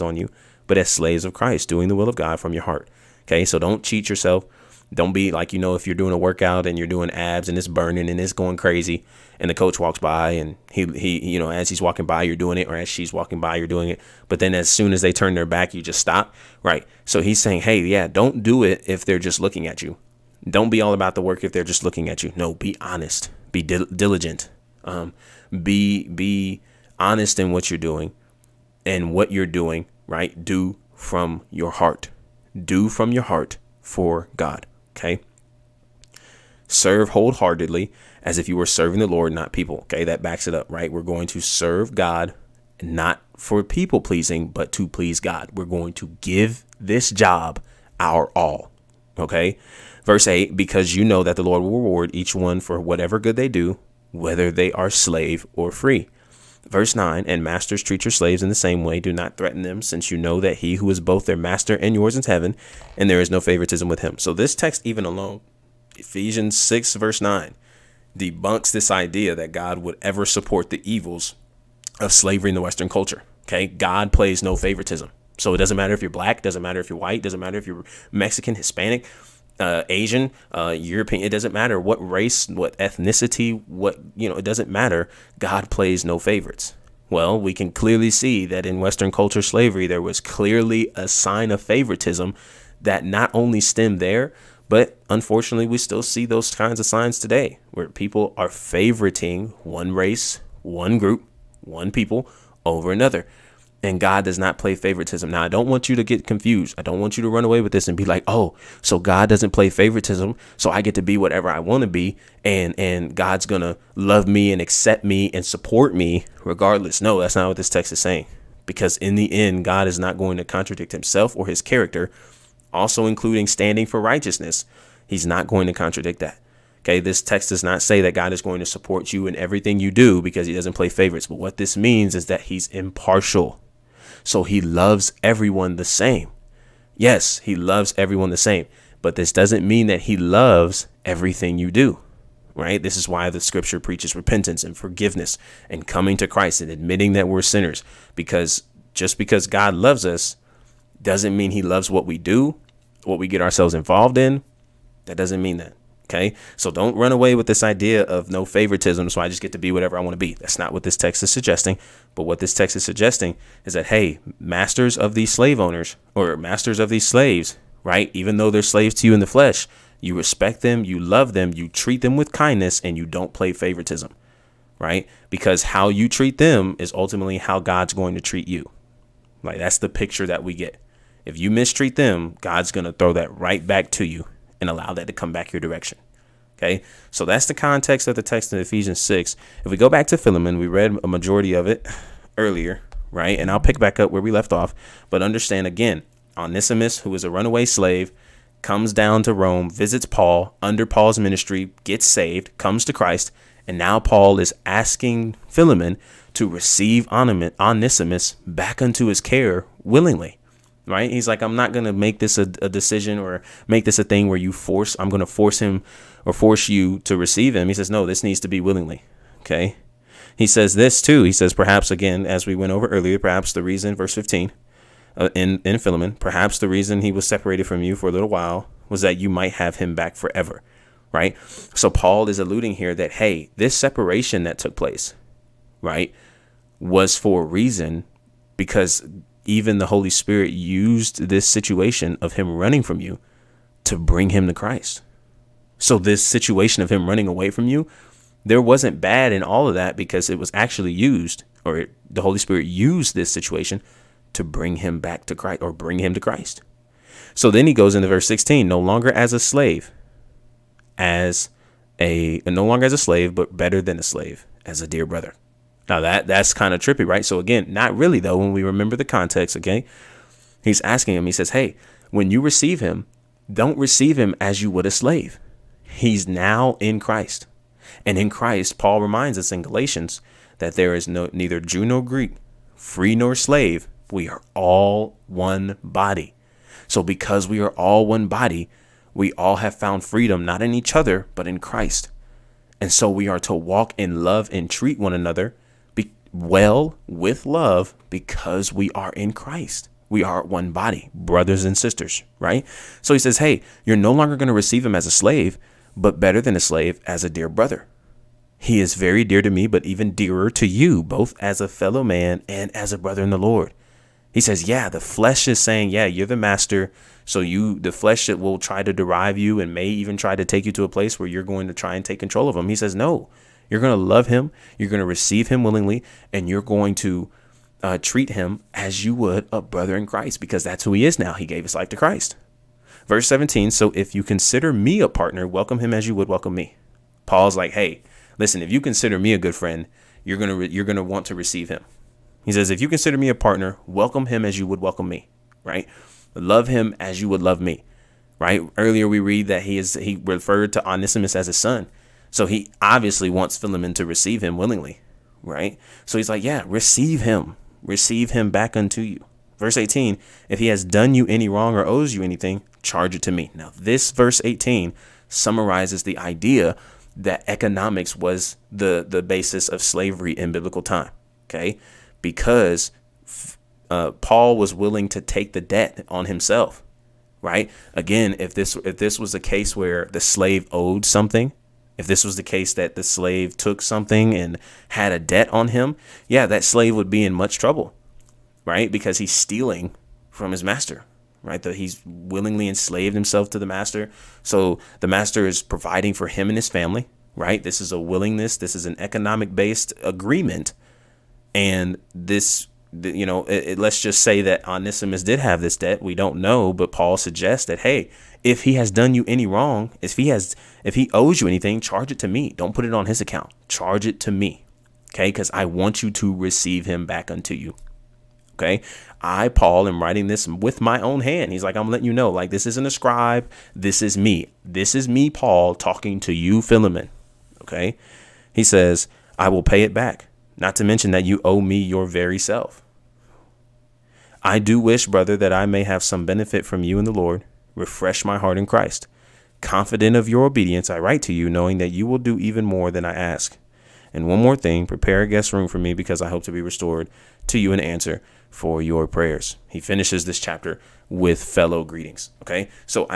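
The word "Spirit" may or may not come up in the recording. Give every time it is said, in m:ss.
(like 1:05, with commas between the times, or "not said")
4:00, 4:12.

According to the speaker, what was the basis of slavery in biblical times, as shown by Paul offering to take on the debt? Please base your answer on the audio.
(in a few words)
economics.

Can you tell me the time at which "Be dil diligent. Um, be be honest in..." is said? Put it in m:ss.
0:23.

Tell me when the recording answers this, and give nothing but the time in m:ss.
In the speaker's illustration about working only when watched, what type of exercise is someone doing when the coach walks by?
0:07.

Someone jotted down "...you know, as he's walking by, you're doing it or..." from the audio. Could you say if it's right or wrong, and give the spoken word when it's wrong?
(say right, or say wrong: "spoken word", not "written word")
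right.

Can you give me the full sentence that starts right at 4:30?
He's asking him, he says, "Hey, when you receive him, don't receive him as you would a slave.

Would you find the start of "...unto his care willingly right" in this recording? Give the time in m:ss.
3:28.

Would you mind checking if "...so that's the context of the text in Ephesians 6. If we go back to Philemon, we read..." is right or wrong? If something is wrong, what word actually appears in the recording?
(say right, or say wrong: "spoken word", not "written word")
right.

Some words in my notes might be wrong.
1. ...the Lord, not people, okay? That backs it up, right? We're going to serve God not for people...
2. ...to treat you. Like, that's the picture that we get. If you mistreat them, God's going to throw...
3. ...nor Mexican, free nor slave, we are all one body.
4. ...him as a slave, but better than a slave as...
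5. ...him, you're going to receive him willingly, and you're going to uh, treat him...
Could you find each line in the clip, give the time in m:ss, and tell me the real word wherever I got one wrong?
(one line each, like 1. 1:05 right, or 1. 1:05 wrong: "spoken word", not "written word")
1. 0:39 right
2. 2:58 right
3. 4:41 wrong: "Greek", not "Mexican"
4. 5:04 right
5. 5:24 right.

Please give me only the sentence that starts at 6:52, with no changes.
Don't put it on his account.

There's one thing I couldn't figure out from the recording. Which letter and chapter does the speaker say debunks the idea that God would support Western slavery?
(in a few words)
Ephesians 6.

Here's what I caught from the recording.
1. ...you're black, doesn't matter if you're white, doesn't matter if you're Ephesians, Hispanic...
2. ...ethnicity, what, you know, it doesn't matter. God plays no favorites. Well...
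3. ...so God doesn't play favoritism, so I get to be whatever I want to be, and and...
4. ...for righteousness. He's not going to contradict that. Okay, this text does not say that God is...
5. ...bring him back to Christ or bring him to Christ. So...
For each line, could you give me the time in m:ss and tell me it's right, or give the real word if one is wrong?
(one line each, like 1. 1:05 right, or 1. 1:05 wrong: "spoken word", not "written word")
1. 1:16 wrong: "Mexican", not "Ephesians"
2. 1:22 right
3. 1:48 right
4. 2:03 right
5. 4:14 right.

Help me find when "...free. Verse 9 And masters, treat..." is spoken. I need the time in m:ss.
0:55.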